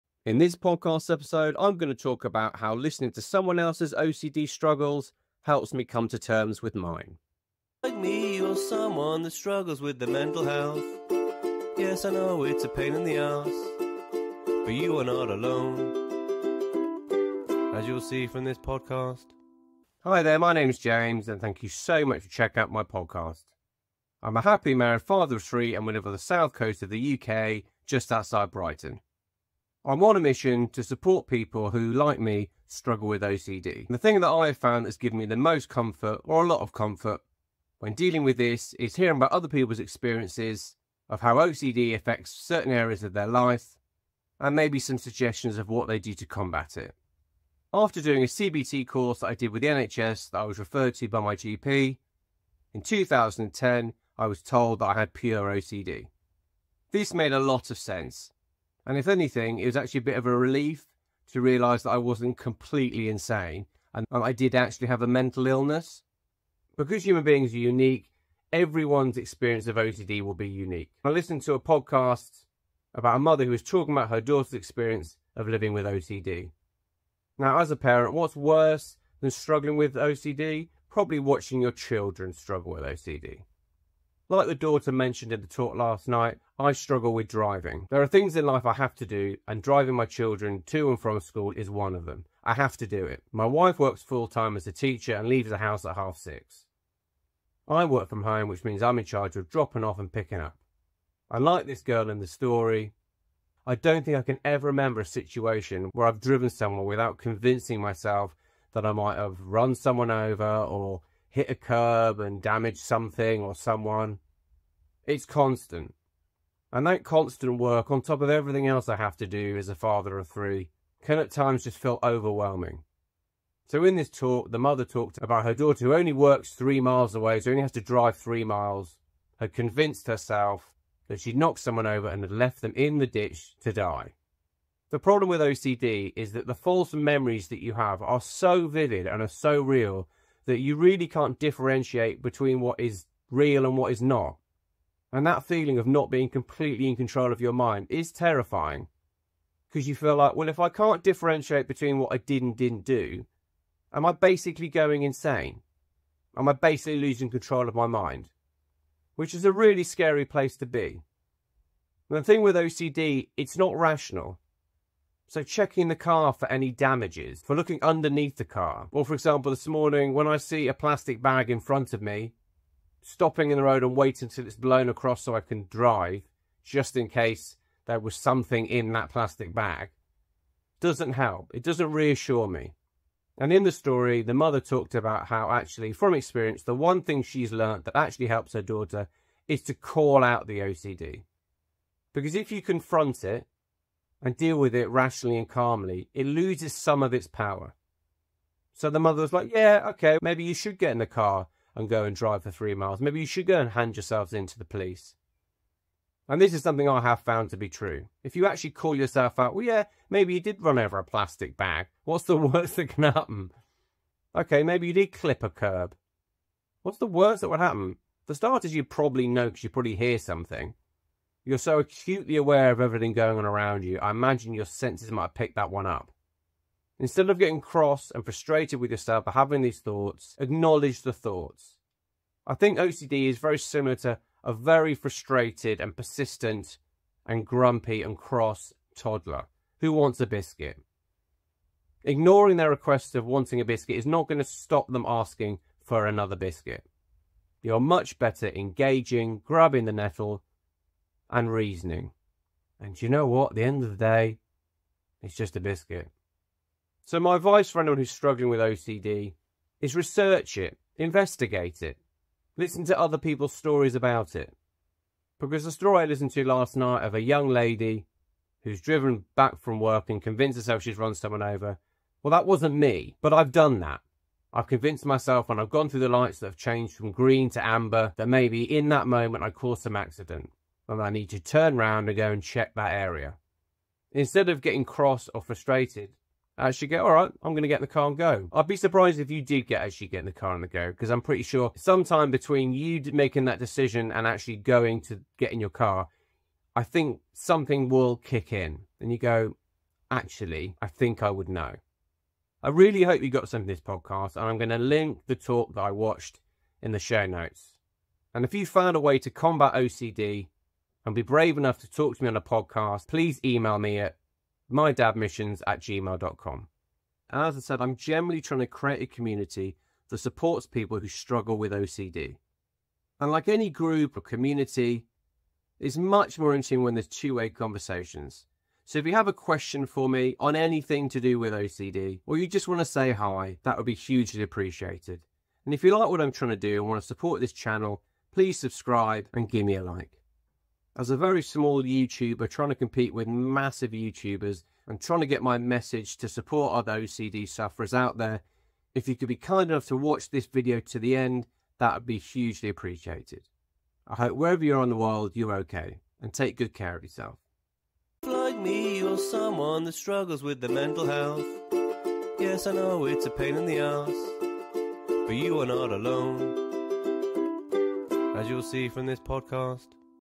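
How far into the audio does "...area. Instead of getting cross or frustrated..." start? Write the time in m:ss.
4:42.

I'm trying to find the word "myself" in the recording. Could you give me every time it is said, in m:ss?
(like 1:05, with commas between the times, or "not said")
1:47, 4:35.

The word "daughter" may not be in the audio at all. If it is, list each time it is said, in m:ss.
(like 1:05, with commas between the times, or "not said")
1:14, 1:24, 2:05, 3:08.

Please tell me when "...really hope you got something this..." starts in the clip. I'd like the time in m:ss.
5:02.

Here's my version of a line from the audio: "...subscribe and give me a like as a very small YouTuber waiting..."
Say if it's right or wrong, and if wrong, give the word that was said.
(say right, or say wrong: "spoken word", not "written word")
wrong: "trying", not "waiting".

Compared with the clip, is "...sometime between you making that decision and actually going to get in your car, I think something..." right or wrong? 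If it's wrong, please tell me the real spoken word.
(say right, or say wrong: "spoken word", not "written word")
right.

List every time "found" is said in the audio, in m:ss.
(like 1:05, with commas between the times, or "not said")
0:34, 3:27, 5:08.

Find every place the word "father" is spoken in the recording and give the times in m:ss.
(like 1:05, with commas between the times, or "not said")
0:25, 1:59.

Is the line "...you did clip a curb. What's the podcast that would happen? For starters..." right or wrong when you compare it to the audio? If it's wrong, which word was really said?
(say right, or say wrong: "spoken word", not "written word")
wrong: "worst", not "podcast".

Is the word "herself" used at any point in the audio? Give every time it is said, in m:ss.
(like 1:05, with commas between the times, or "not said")
2:10, 4:30.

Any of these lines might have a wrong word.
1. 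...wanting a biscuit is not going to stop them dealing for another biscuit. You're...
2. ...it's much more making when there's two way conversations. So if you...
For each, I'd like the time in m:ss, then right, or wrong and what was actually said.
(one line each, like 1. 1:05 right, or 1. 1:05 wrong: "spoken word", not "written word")
1. 4:03 wrong: "asking", not "dealing"
2. 5:25 wrong: "interesting", not "making".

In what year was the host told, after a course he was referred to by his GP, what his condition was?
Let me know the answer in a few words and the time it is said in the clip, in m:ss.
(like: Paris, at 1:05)
2010, at 0:52.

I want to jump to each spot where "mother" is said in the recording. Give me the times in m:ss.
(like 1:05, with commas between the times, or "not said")
1:13, 2:04, 3:04, 3:18.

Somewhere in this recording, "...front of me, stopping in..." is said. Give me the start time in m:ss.
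2:51.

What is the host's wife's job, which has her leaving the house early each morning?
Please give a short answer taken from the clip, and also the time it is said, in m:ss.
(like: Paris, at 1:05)
Teacher, at 1:34.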